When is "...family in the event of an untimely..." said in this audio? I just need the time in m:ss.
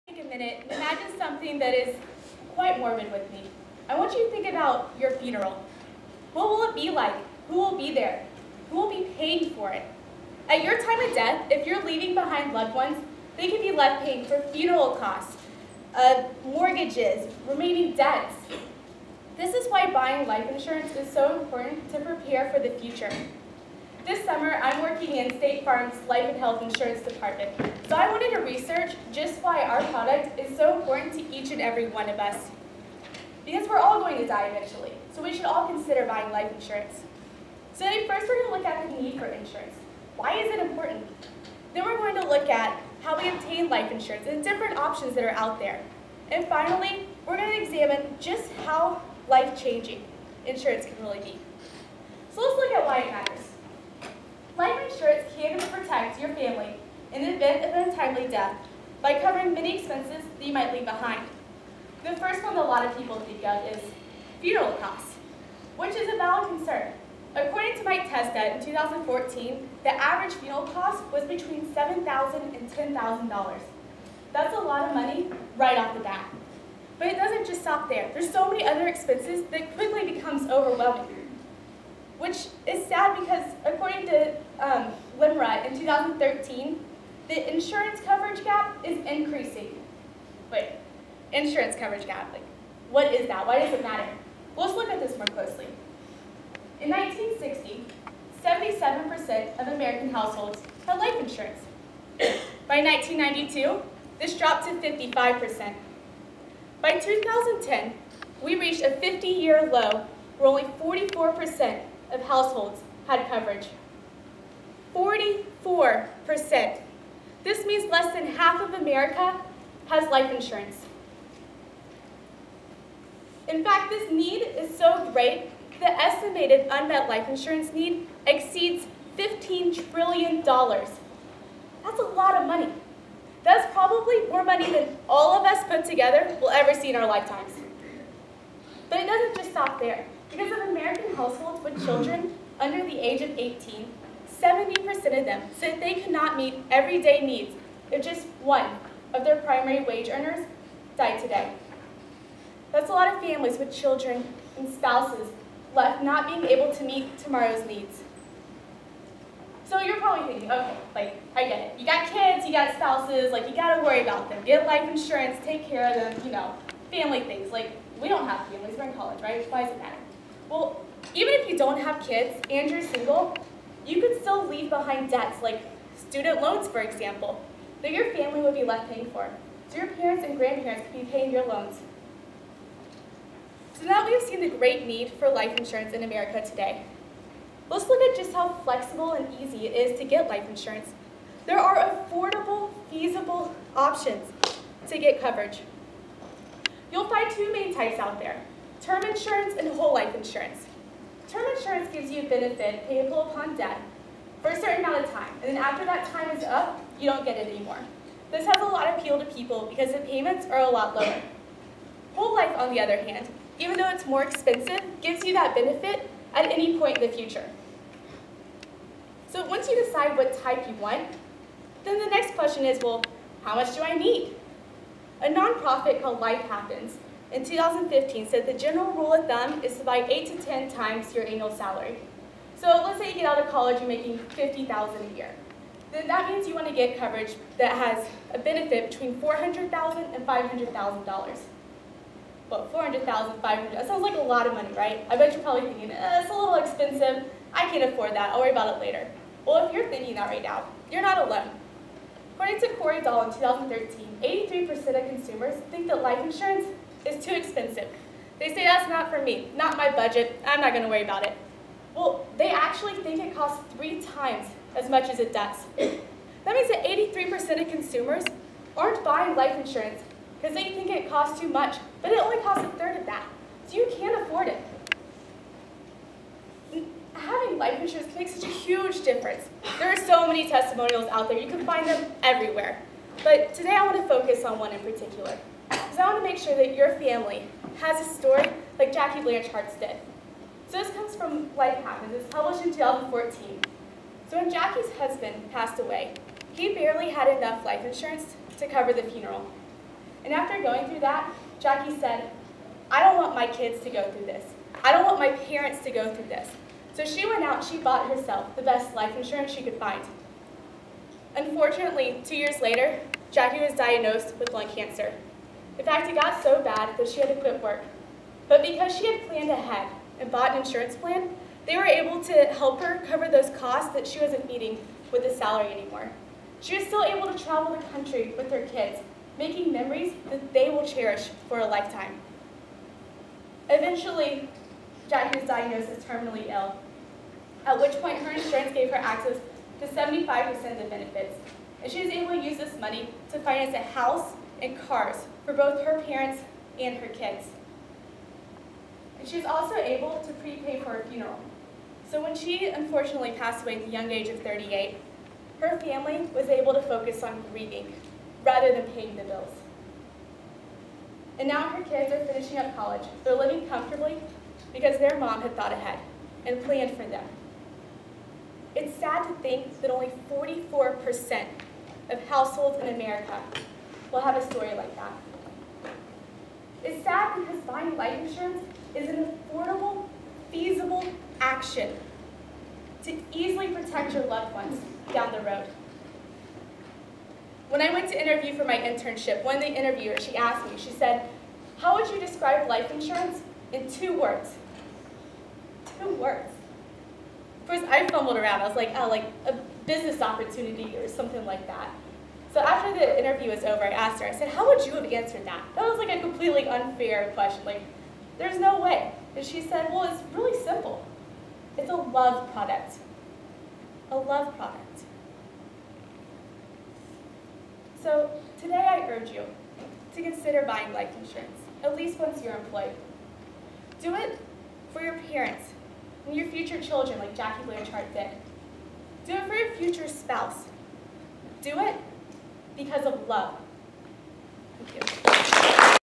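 0:56.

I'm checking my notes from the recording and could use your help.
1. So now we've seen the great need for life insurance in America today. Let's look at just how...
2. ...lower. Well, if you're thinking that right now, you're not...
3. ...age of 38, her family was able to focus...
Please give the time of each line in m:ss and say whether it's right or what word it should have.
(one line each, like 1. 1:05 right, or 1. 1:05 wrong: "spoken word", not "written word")
1. 3:03 right
2. 4:08 wrong: "later", not "lower"
3. 5:54 right.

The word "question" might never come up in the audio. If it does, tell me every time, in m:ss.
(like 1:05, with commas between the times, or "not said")
3:42, 6:47.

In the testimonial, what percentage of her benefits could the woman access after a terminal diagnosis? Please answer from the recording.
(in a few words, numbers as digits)
75%.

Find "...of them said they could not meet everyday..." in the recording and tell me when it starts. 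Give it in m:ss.
2:25.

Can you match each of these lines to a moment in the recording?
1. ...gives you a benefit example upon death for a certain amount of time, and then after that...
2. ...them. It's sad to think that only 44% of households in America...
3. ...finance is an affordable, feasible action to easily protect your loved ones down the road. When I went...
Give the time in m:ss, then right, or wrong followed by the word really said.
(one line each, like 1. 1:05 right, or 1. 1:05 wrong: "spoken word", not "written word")
1. 3:21 wrong: "payable", not "example"
2. 6:07 right
3. 6:18 wrong: "insurance", not "finance".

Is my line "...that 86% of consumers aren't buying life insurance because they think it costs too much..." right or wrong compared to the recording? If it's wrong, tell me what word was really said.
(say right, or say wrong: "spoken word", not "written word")
wrong: "83", not "86".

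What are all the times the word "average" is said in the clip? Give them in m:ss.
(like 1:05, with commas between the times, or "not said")
1:09.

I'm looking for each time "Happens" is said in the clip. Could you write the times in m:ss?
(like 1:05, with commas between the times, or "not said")
3:46, 4:51.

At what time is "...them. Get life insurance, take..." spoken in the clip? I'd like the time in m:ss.
2:44.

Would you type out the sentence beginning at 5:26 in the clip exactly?
She was still able to travel the country with her kids, making memories that they will cherish for a lifetime.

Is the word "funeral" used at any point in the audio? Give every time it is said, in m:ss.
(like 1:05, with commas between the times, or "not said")
0:05, 0:14, 1:04, 1:10, 4:59, 5:51.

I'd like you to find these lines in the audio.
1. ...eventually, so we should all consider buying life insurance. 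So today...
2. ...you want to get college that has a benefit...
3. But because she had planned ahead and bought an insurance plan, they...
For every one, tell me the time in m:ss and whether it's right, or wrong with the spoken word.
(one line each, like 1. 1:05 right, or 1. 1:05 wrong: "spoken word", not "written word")
1. 0:34 right
2. 3:56 wrong: "coverage", not "college"
3. 5:18 right.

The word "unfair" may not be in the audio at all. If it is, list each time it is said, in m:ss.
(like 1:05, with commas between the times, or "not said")
6:46.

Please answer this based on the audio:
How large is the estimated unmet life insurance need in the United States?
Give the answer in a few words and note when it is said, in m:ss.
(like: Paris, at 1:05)
$15 trillion, at 2:09.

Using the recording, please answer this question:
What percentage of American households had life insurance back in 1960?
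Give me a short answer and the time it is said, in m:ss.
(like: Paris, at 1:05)
77%, at 1:38.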